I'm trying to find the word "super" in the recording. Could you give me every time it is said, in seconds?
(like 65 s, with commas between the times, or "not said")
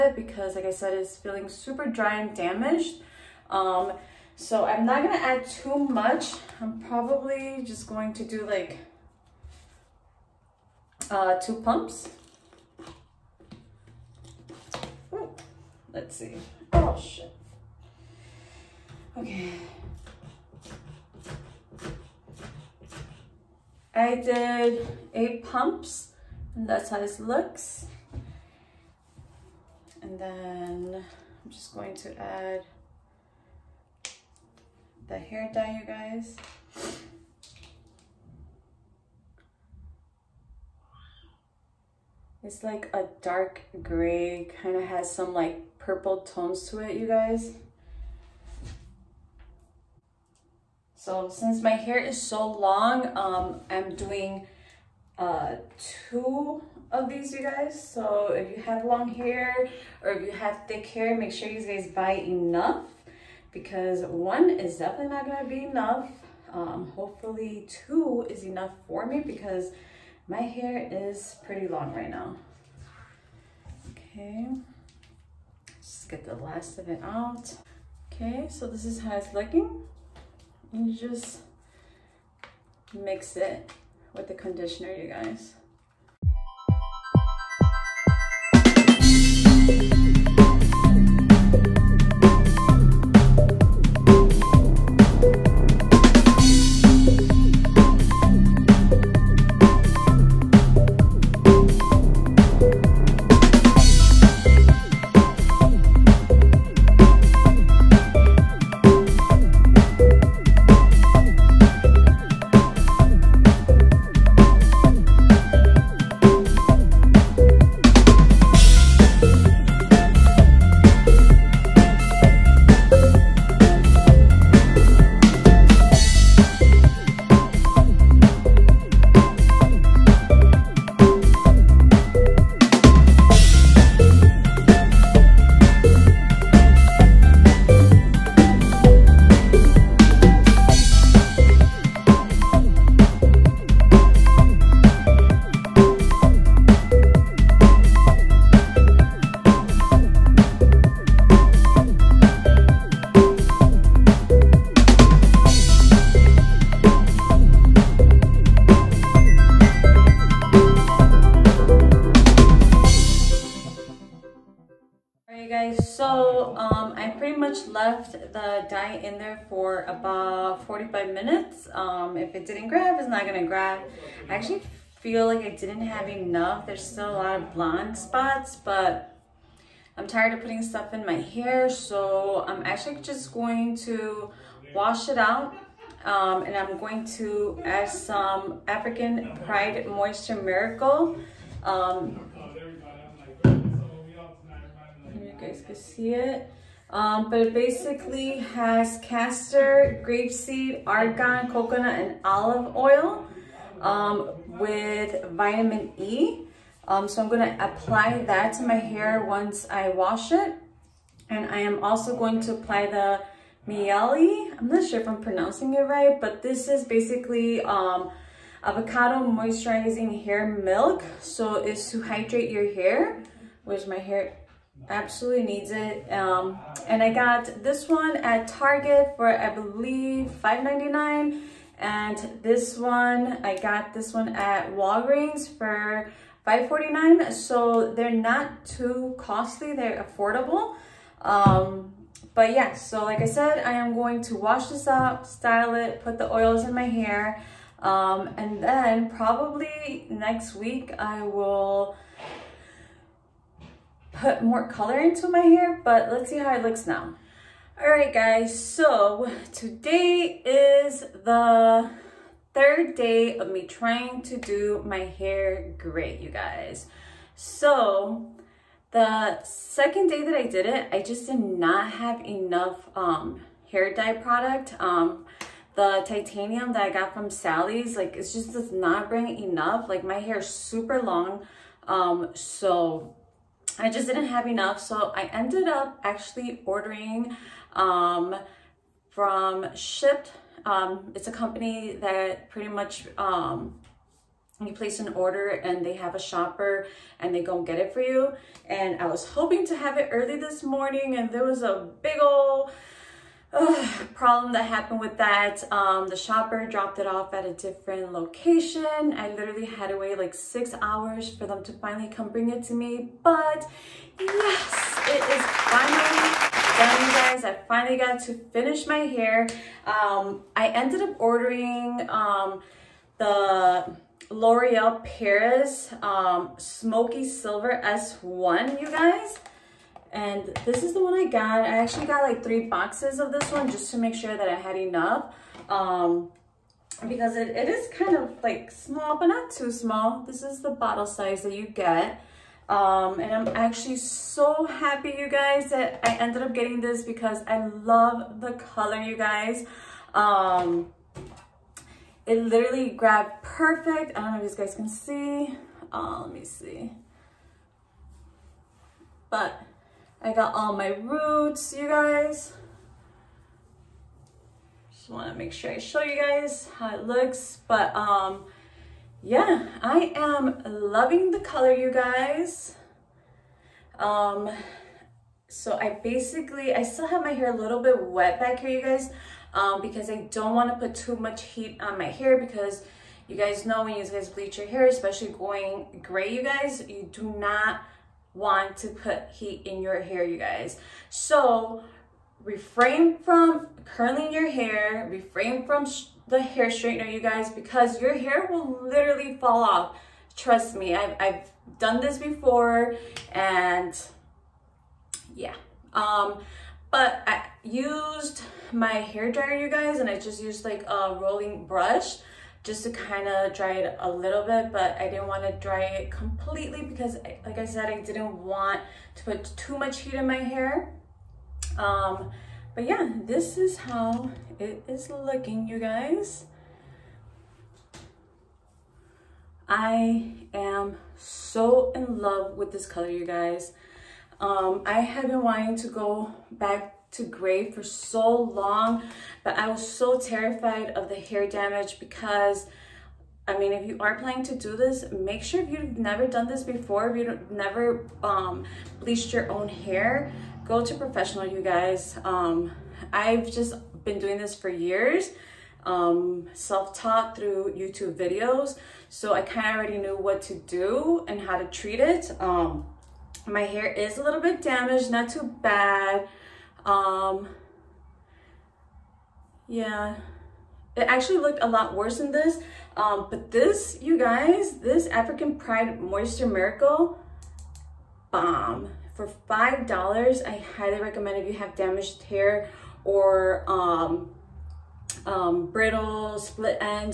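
1 s, 280 s.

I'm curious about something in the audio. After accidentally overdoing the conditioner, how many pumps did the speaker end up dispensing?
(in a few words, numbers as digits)
8.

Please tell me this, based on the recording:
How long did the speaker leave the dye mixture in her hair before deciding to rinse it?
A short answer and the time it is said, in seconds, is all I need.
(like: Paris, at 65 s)
45 minutes, at 170 s.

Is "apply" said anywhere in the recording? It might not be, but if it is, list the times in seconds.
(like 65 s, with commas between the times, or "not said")
207 s, 212 s.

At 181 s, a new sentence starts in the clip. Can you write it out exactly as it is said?
So I'm actually just going to wash it out um, and I'm going to add some African Pride Moisture Miracle.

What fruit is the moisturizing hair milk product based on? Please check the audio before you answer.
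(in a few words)
Avocado.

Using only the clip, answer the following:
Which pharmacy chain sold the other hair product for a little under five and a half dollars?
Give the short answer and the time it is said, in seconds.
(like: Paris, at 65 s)
Walgreens, at 234 s.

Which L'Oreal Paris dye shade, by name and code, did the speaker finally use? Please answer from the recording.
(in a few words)
Smoky Silver S1.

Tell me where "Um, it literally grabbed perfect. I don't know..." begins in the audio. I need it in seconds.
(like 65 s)
350 s.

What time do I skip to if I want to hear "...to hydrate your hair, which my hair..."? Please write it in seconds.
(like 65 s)
221 s.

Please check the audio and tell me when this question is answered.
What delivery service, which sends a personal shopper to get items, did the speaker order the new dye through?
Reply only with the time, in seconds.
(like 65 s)
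289 s.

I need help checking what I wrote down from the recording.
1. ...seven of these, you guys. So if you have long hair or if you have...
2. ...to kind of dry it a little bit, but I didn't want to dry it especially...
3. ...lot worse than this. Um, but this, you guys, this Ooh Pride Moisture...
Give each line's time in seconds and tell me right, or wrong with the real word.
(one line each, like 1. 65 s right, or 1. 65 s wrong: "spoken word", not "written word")
1. 55 s wrong: "two", not "seven"
2. 412 s wrong: "completely", not "especially"
3. 471 s wrong: "African", not "Ooh".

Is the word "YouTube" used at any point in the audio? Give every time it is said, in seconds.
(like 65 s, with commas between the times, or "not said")
457 s.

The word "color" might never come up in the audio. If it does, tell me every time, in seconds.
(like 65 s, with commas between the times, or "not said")
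254 s, 348 s, 371 s, 432 s.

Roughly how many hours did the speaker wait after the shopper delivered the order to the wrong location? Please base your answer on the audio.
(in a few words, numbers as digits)
6.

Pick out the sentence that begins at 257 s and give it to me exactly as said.
All right, guys, so today is the third day of me trying to do my hair gray, you guys.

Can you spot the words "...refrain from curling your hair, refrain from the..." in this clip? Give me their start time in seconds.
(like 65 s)
392 s.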